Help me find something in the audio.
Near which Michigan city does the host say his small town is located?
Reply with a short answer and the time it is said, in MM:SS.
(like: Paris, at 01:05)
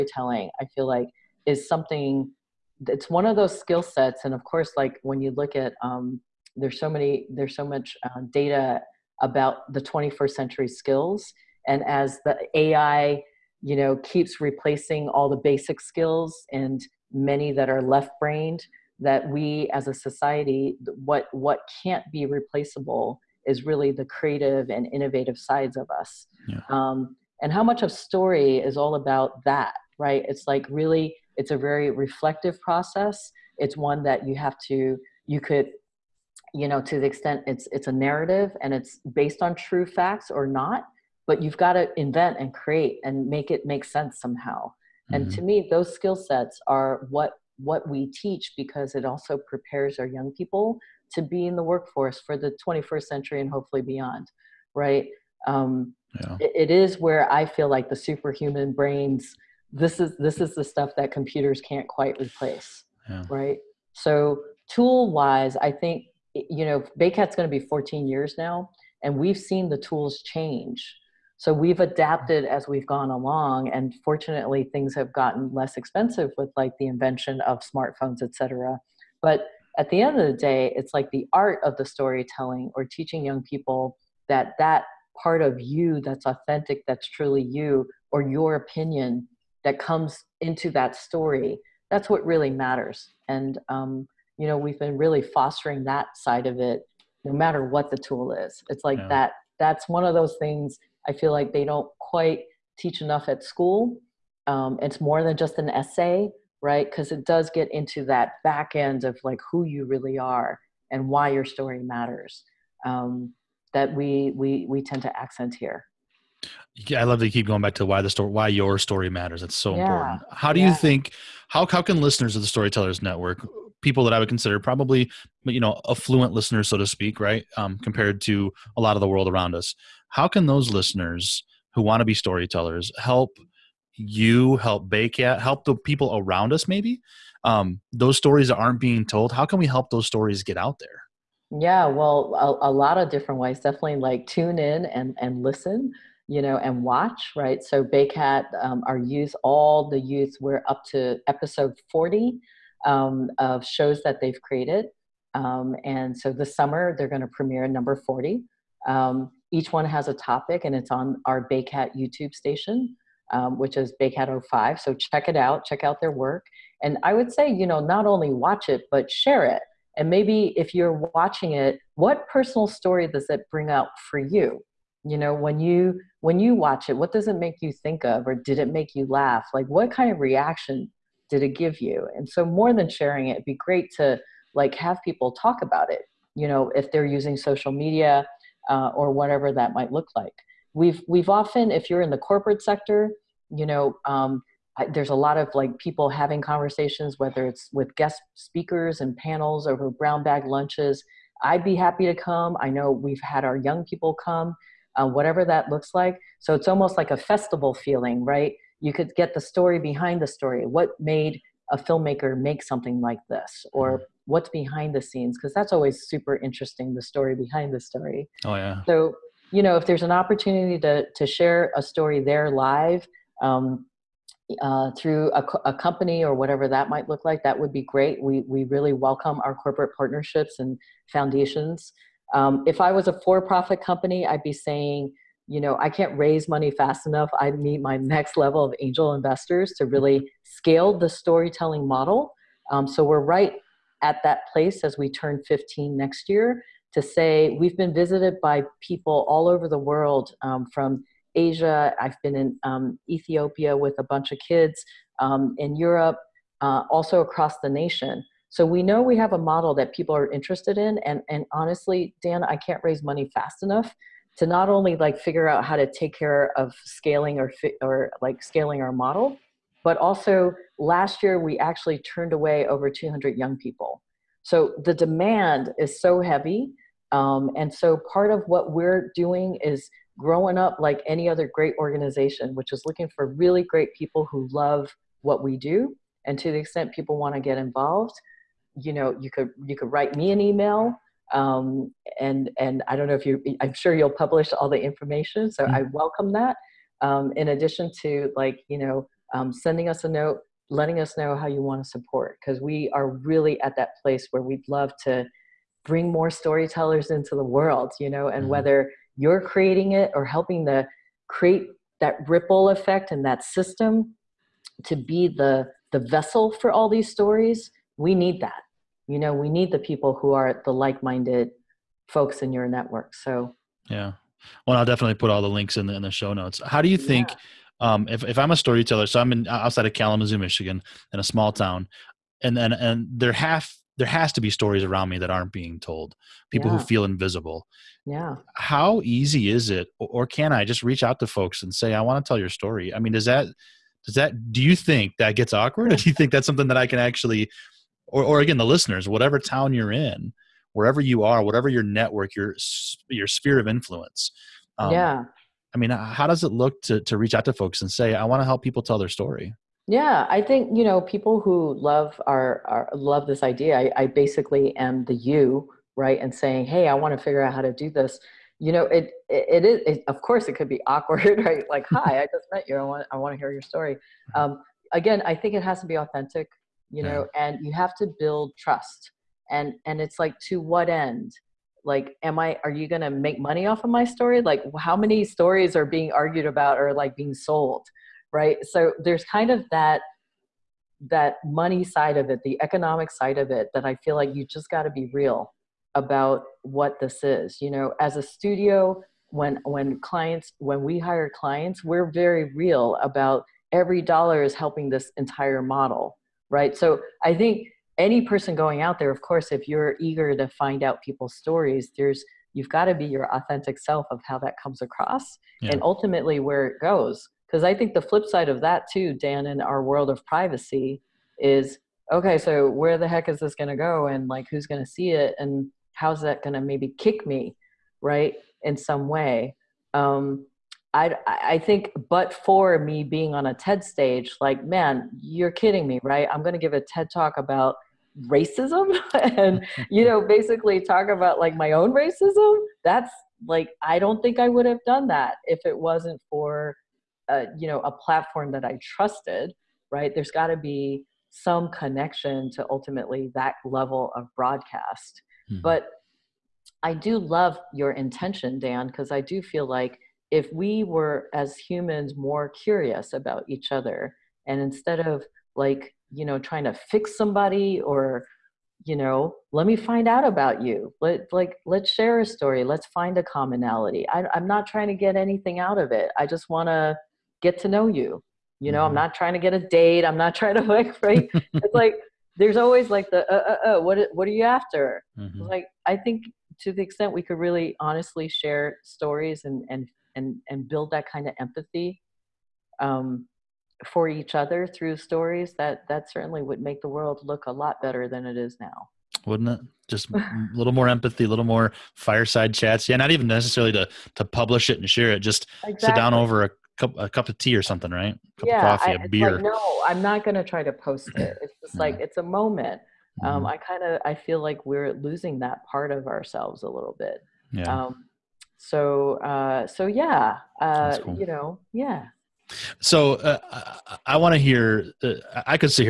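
Kalamazoo, at 05:29.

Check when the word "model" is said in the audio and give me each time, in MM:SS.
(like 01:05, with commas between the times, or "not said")
04:01, 04:19, 04:28, 06:45.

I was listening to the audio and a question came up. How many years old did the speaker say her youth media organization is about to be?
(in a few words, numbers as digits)
14.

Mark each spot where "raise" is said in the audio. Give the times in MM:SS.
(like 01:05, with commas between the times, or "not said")
03:56, 04:22.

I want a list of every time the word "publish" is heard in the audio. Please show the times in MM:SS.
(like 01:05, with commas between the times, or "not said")
04:54, 08:24.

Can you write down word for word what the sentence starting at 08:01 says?
it's like there's always like the, uh, uh, uh what, what are you after?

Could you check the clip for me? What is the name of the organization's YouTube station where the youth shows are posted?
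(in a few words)
Baycat 05.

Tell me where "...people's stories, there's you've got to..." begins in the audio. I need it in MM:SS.
06:51.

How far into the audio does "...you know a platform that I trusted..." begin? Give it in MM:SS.
07:27.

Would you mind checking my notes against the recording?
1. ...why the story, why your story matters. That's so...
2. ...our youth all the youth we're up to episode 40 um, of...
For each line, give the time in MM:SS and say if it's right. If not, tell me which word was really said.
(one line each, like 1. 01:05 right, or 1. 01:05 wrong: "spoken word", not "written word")
1. 01:57 right
2. 02:28 right.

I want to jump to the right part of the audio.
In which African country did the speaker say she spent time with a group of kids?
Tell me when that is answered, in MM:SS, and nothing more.
04:13.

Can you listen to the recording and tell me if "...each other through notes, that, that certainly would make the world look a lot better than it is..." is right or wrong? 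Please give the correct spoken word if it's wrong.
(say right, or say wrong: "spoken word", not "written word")
wrong: "stories", not "notes".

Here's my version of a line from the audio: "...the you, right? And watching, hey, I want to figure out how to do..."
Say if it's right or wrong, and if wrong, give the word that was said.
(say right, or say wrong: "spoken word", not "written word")
wrong: "saying", not "watching".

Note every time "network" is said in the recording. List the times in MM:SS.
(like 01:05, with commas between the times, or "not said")
02:02, 05:22, 05:51.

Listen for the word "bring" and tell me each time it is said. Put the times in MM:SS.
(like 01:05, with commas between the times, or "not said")
02:53, 05:05.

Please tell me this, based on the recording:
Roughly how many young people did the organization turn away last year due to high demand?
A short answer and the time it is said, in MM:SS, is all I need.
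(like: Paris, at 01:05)
over 200, at 04:32.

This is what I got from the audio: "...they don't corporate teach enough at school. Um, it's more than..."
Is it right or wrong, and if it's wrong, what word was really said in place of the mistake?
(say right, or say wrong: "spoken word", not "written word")
wrong: "quite", not "corporate".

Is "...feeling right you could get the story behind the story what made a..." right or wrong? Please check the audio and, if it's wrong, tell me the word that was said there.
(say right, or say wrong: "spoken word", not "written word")
right.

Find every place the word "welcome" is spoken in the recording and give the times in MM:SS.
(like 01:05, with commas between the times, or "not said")
03:48, 04:55.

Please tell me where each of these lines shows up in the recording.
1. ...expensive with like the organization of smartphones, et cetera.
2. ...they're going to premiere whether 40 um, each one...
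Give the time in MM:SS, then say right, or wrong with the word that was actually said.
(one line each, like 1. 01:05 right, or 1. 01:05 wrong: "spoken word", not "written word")
1. 01:15 wrong: "invention", not "organization"
2. 02:36 wrong: "number", not "whether".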